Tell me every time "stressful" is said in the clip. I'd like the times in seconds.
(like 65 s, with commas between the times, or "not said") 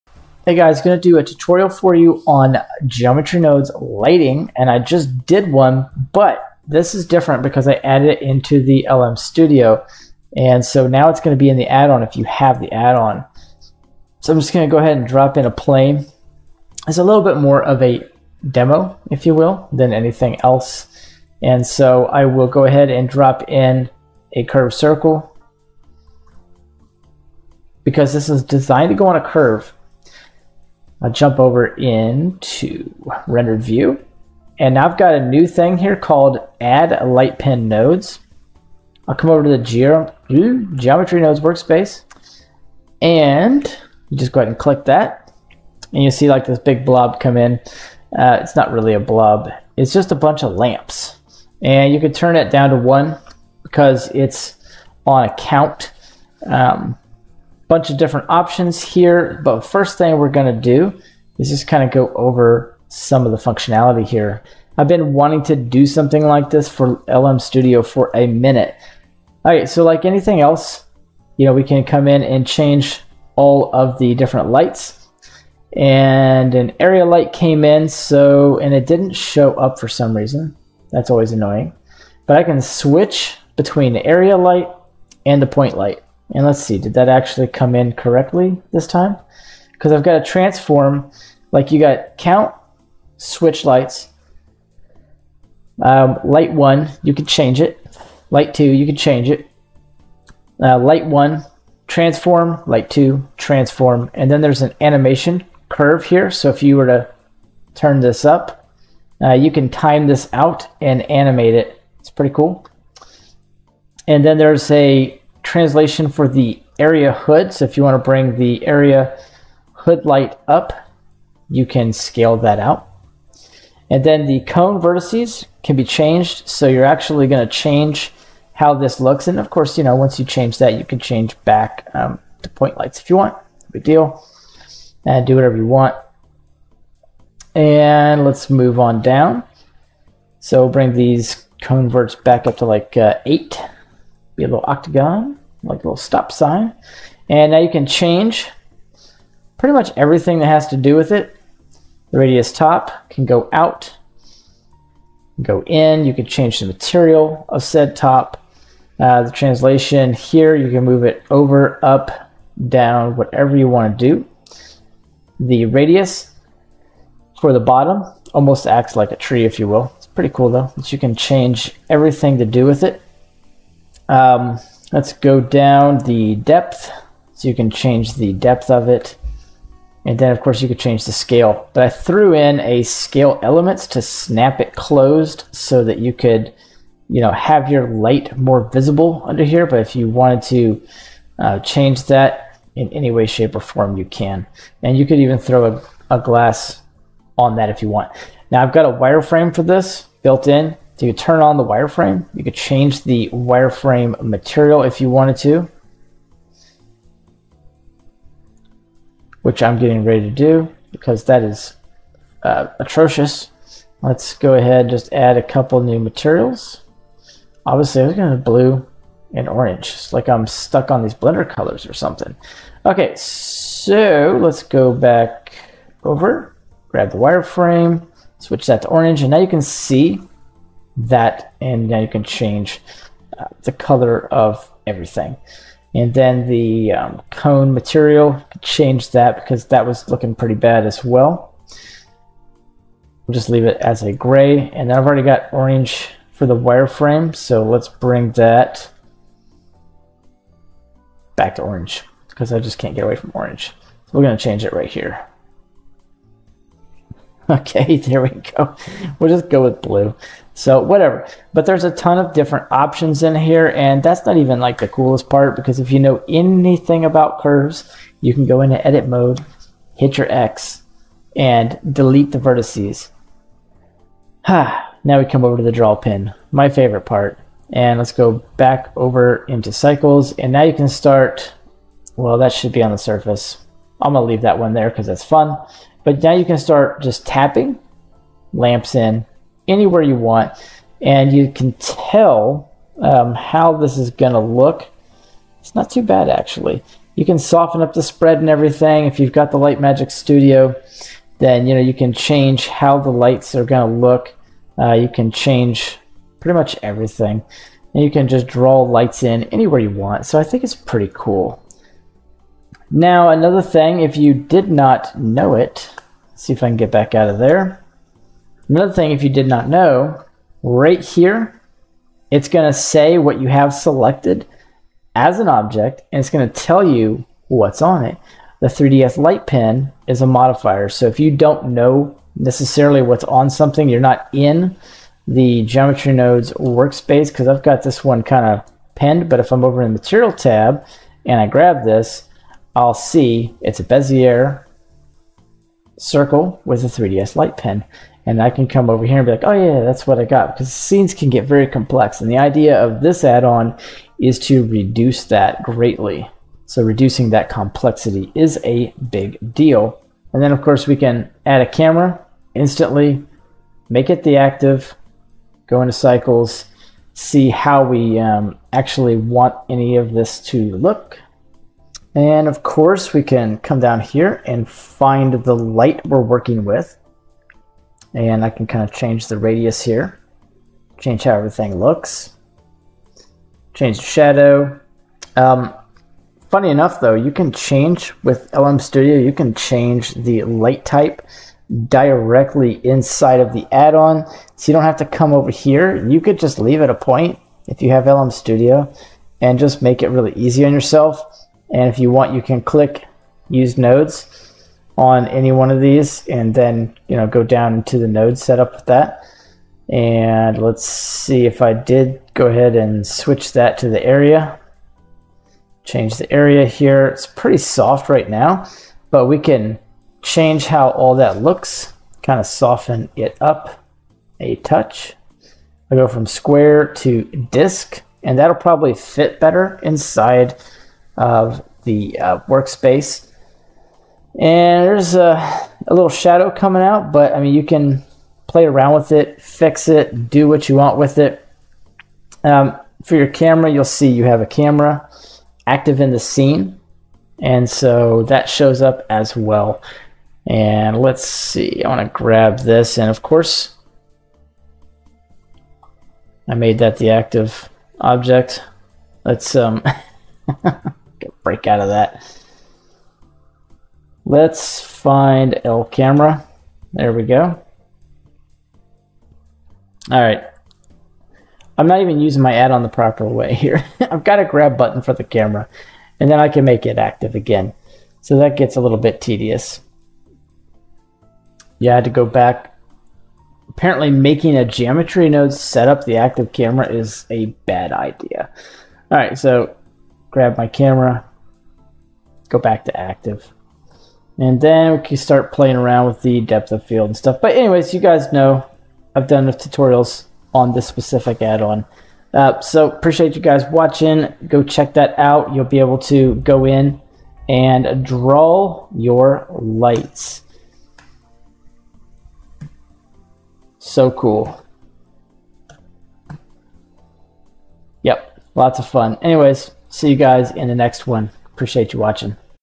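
not said.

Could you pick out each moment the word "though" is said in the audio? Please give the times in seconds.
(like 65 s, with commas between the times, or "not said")
170 s, 386 s.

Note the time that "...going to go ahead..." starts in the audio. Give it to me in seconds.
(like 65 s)
14 s.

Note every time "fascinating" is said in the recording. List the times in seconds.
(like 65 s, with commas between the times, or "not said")
not said.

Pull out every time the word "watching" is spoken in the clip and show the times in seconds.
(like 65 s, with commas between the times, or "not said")
503 s, 521 s.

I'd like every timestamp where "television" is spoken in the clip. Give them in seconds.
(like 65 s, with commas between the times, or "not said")
not said.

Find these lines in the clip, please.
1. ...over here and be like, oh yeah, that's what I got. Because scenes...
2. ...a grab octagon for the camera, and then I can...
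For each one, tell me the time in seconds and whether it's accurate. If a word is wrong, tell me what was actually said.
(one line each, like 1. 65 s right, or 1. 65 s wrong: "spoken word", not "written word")
1. 348 s right
2. 474 s wrong: "button", not "octagon".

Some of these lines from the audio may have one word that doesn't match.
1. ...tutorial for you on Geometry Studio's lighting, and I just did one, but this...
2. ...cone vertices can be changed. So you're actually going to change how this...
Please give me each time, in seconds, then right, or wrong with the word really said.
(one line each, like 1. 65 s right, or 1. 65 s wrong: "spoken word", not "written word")
1. 1 s wrong: "Node", not "Studio"
2. 124 s right.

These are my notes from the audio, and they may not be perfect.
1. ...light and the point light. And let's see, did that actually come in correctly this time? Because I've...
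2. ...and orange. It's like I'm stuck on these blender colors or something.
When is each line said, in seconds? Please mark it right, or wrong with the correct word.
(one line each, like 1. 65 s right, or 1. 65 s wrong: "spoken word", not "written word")
1. 84 s right
2. 219 s right.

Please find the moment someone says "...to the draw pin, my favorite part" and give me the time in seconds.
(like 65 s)
275 s.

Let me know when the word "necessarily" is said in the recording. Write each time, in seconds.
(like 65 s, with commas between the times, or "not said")
332 s.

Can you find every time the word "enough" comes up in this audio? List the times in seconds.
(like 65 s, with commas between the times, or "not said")
386 s, 499 s.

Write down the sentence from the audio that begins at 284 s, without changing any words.
I'm gonna leave that one there because it's fun.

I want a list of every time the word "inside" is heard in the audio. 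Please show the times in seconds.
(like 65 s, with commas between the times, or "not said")
392 s, 429 s.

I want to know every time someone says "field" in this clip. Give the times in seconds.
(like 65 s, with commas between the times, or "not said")
496 s.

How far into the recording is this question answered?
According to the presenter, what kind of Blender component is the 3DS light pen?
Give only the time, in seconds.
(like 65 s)
330 s.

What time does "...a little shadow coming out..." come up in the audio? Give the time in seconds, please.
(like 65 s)
435 s.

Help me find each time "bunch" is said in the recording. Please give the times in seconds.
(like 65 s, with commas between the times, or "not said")
50 s, 57 s.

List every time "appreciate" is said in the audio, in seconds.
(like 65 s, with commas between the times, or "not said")
502 s, 521 s.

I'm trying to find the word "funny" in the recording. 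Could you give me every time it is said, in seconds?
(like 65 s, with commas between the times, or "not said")
386 s.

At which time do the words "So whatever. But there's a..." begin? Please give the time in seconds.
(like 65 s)
260 s.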